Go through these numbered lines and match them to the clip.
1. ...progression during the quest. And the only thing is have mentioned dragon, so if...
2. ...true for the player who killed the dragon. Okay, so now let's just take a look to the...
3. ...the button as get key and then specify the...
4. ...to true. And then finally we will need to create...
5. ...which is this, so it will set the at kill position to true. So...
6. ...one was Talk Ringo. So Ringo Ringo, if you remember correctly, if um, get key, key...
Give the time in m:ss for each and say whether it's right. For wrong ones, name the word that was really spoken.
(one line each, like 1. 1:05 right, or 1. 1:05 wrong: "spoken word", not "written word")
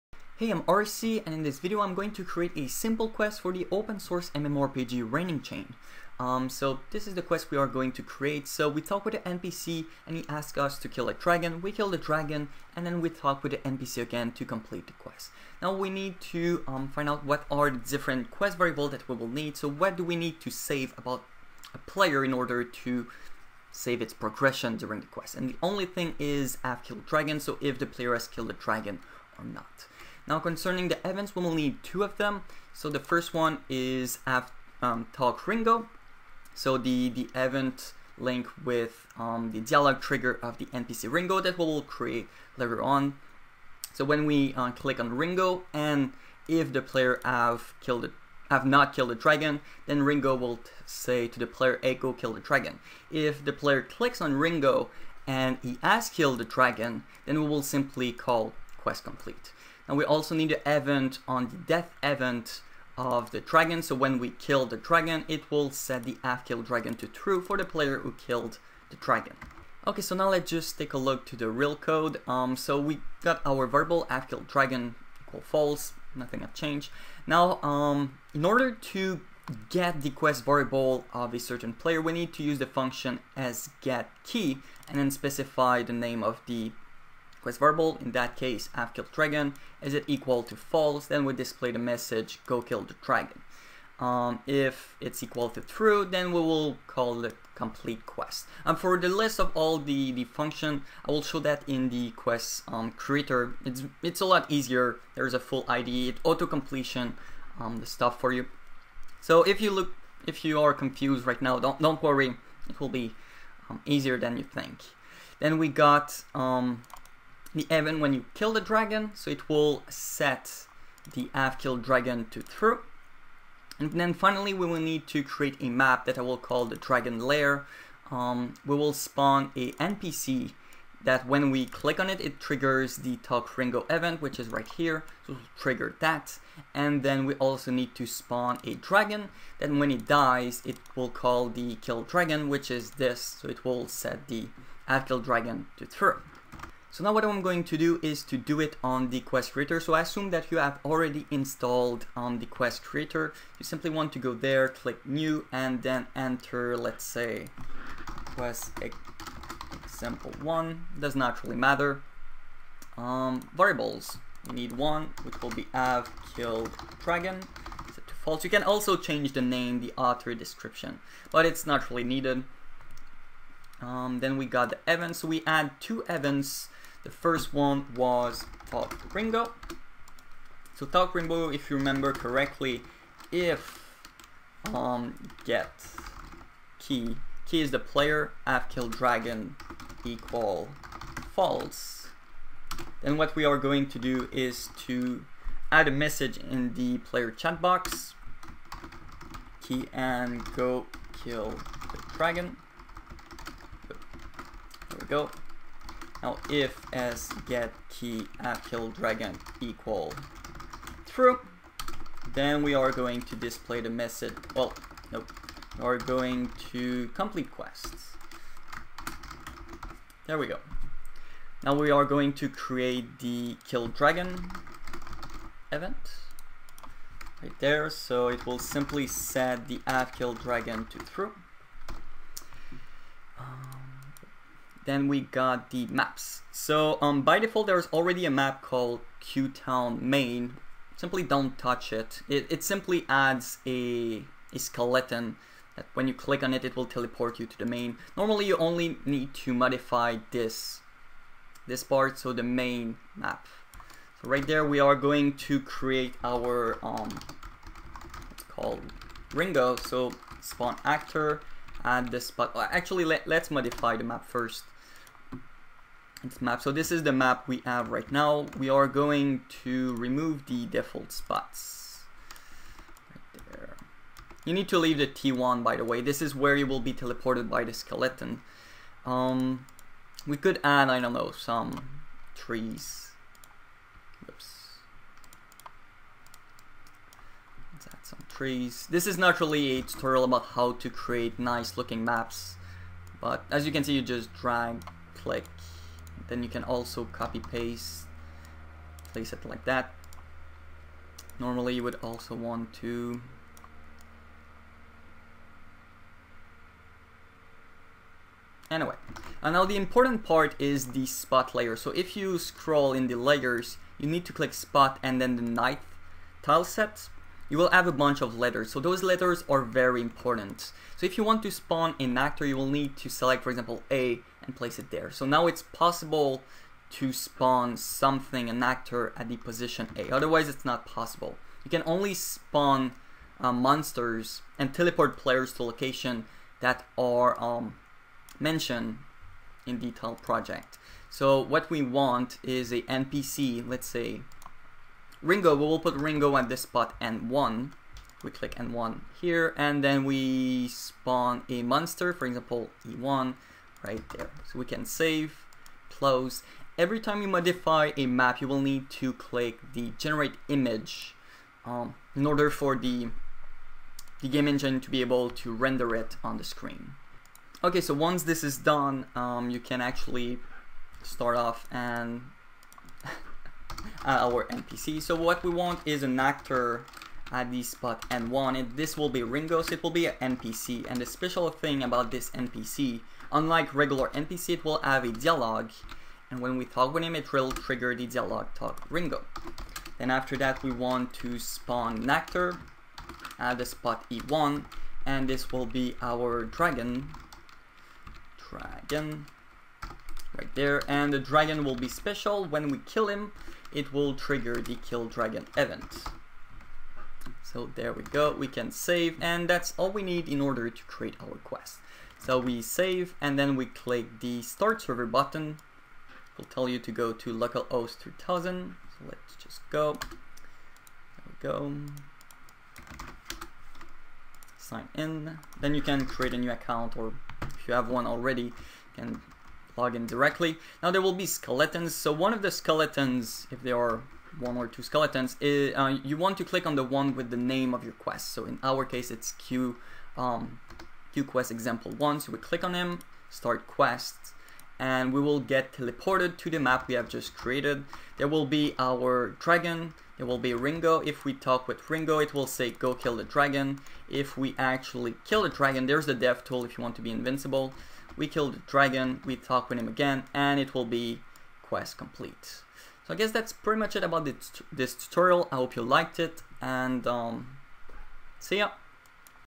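1. 0:24 wrong: "killed", not "mentioned"
2. 1:07 right
3. 1:22 wrong: "function", not "button"
4. 2:02 right
5. 2:22 wrong: "dragon", not "position"
6. 2:57 wrong: "Talk", not "Ringo".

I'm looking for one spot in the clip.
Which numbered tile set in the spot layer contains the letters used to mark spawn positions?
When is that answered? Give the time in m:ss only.
5:15.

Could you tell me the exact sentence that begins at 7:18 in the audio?
So in our case, it's Q, um, Q quest example one.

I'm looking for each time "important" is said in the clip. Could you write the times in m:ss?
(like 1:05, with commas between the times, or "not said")
5:09, 5:20.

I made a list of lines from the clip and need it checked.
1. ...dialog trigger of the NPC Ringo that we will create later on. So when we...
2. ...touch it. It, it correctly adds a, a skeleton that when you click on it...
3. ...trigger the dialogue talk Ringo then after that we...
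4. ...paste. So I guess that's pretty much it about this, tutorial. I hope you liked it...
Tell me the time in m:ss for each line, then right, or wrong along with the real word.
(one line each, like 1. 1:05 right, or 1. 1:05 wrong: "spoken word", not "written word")
1. 0:39 right
2. 4:01 wrong: "simply", not "correctly"
3. 6:27 right
4. 7:41 wrong: "complete", not "paste".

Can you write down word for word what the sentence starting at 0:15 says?
Now we need to um, find out what are the different quest variables that we will need.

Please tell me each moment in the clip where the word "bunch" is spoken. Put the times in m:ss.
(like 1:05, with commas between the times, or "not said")
5:17.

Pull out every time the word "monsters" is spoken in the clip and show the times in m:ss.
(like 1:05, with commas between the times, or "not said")
5:33, 5:51.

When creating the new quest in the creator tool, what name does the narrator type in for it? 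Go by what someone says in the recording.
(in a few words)
Quest Example 1.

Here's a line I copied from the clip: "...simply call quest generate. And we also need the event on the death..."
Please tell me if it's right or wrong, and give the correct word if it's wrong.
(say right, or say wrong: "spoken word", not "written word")
wrong: "complete", not "generate".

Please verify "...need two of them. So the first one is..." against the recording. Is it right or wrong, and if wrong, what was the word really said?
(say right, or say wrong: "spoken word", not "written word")
right.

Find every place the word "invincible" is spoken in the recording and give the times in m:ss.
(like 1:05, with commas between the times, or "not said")
7:37.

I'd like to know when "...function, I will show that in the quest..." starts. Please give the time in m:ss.
1:40.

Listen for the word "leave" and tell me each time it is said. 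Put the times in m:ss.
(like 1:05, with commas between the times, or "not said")
4:34.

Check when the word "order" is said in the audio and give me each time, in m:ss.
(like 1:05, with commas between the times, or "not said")
0:22, 1:18, 6:02, 6:50.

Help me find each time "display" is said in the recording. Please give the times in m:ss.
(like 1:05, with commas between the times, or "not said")
1:31, 3:33.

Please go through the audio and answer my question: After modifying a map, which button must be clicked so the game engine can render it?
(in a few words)
generate image.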